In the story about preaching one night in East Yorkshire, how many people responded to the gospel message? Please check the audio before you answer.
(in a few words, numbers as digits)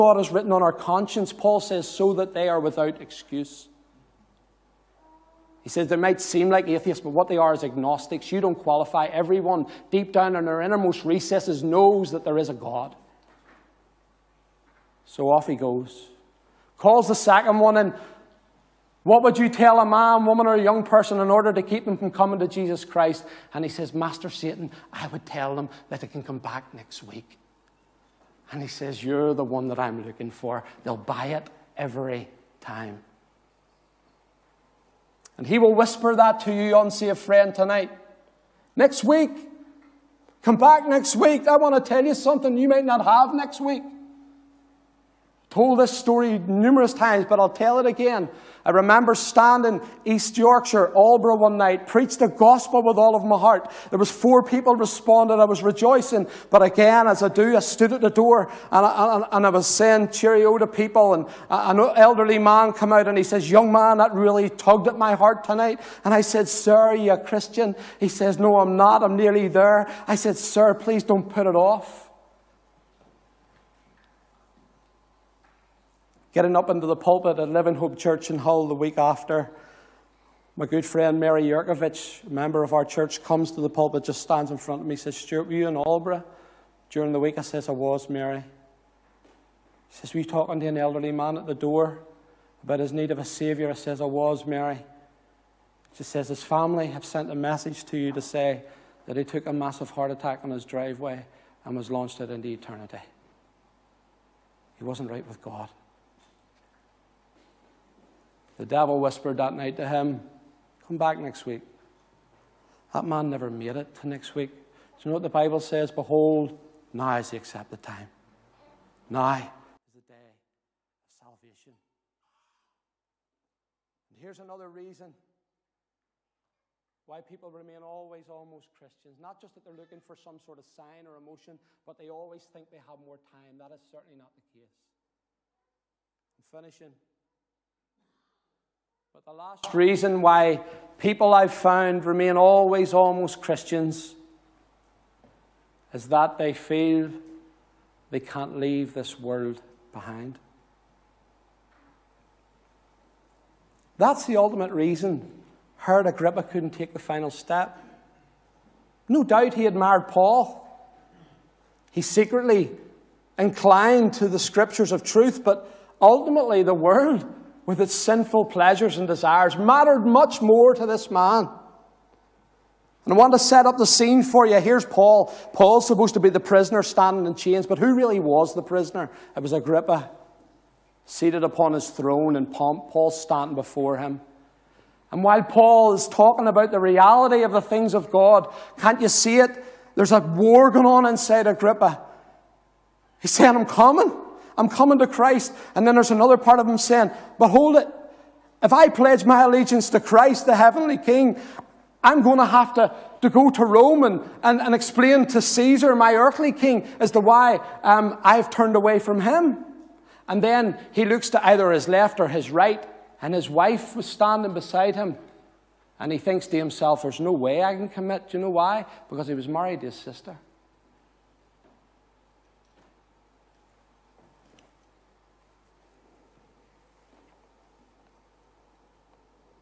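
4.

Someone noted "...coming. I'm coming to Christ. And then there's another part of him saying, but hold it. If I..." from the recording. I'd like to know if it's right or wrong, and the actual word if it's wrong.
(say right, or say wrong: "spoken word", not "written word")
right.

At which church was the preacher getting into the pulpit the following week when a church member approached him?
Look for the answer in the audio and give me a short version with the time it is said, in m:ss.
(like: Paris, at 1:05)
Living Hope Church, at 1:17.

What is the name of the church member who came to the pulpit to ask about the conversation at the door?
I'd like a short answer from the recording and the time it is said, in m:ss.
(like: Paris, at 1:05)
Mary Yurkovich, at 1:21.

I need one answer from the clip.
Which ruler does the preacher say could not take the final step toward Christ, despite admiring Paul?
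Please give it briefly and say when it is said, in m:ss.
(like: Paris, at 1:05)
Herod Agrippa, at 2:35.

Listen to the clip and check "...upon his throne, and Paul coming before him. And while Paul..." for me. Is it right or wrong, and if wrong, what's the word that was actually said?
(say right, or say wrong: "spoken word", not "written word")
wrong: "standing", not "coming".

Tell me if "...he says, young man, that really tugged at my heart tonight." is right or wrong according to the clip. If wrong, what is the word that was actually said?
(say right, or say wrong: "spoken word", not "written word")
right.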